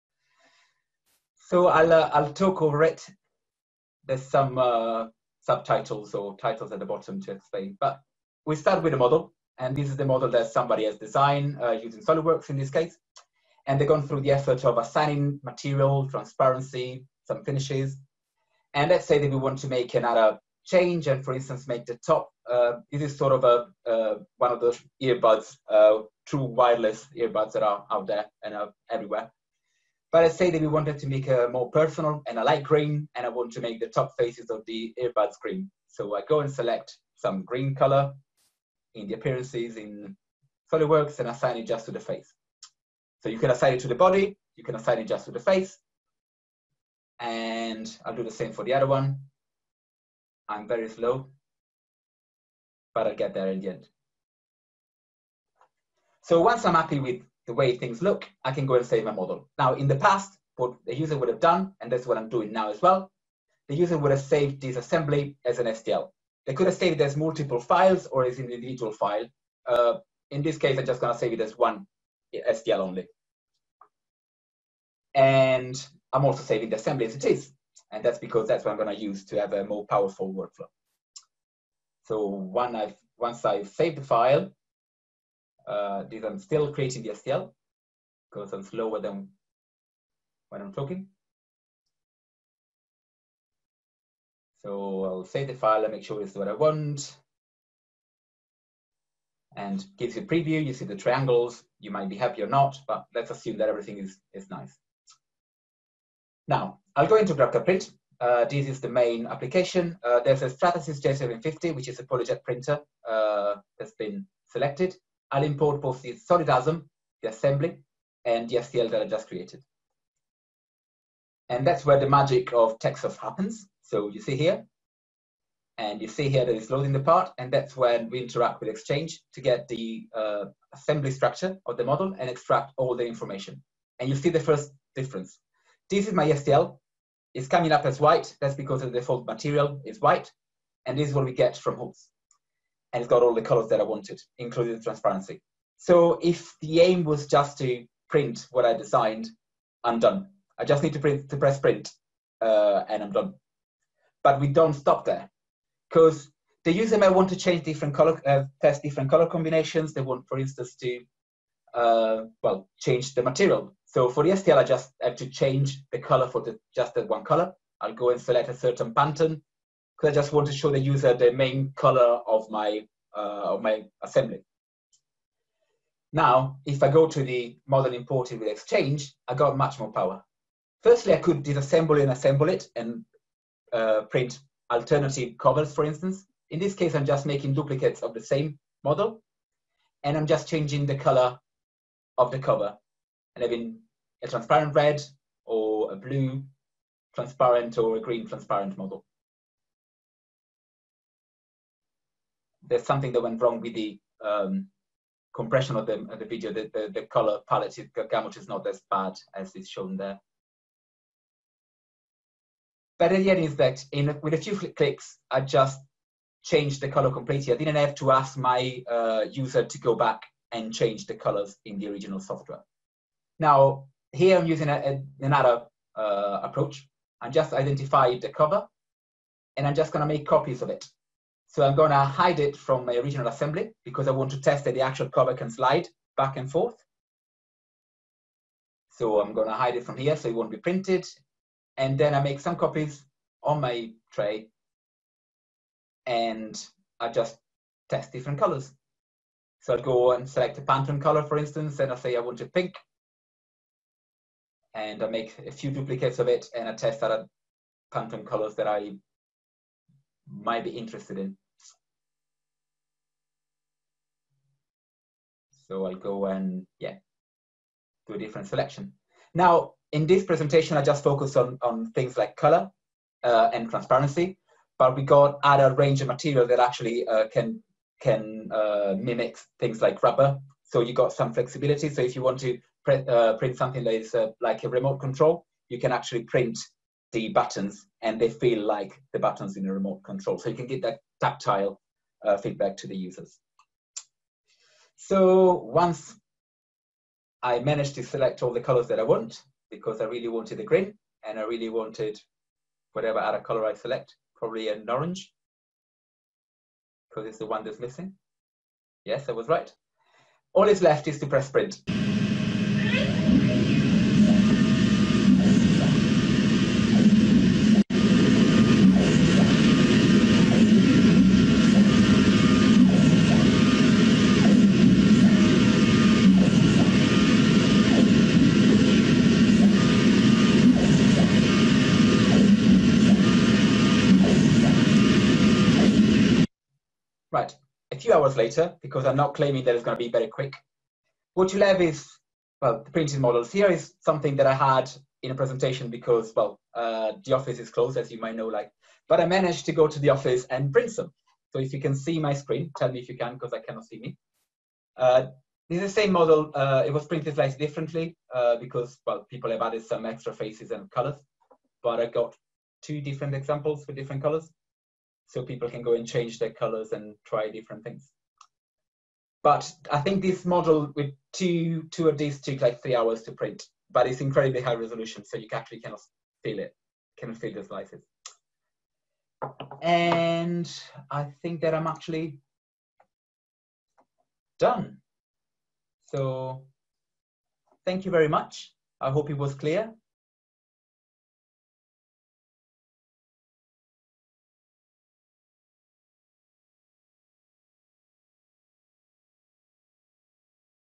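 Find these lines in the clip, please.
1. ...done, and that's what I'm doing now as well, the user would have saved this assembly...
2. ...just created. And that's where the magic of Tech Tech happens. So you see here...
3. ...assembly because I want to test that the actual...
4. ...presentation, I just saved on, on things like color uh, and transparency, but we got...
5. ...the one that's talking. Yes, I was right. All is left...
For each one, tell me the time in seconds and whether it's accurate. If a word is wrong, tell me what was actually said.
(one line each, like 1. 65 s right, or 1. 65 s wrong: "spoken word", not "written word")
1. 61 s right
2. 119 s wrong: "Soft", not "Tech"
3. 233 s right
4. 270 s wrong: "focused", not "saved"
5. 307 s wrong: "missing", not "talking".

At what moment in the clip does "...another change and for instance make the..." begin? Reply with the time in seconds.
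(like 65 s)
19 s.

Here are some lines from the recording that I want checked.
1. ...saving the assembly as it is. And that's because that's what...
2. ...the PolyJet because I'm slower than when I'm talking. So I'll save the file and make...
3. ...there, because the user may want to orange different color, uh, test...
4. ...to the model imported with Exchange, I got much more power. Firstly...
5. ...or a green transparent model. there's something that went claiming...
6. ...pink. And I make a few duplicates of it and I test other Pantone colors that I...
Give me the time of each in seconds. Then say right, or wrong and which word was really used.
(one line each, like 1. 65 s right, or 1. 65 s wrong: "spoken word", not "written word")
1. 76 s right
2. 87 s wrong: "STL", not "PolyJet"
3. 155 s wrong: "change", not "orange"
4. 177 s right
5. 197 s wrong: "wrong", not "claiming"
6. 252 s right.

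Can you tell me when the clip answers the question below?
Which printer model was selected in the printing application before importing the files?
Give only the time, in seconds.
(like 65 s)
110 s.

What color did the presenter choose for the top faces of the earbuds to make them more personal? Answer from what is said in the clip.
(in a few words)
light green.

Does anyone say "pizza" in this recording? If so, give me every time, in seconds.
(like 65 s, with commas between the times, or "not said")
not said.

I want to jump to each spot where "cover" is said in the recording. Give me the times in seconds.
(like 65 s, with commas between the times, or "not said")
185 s, 192 s, 228 s, 235 s.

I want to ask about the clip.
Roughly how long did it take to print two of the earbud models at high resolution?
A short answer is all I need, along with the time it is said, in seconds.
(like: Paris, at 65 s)
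3 hours, at 372 s.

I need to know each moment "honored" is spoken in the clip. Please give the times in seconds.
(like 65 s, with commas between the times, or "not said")
not said.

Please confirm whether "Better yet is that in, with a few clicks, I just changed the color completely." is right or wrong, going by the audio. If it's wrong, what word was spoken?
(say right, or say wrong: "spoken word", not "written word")
right.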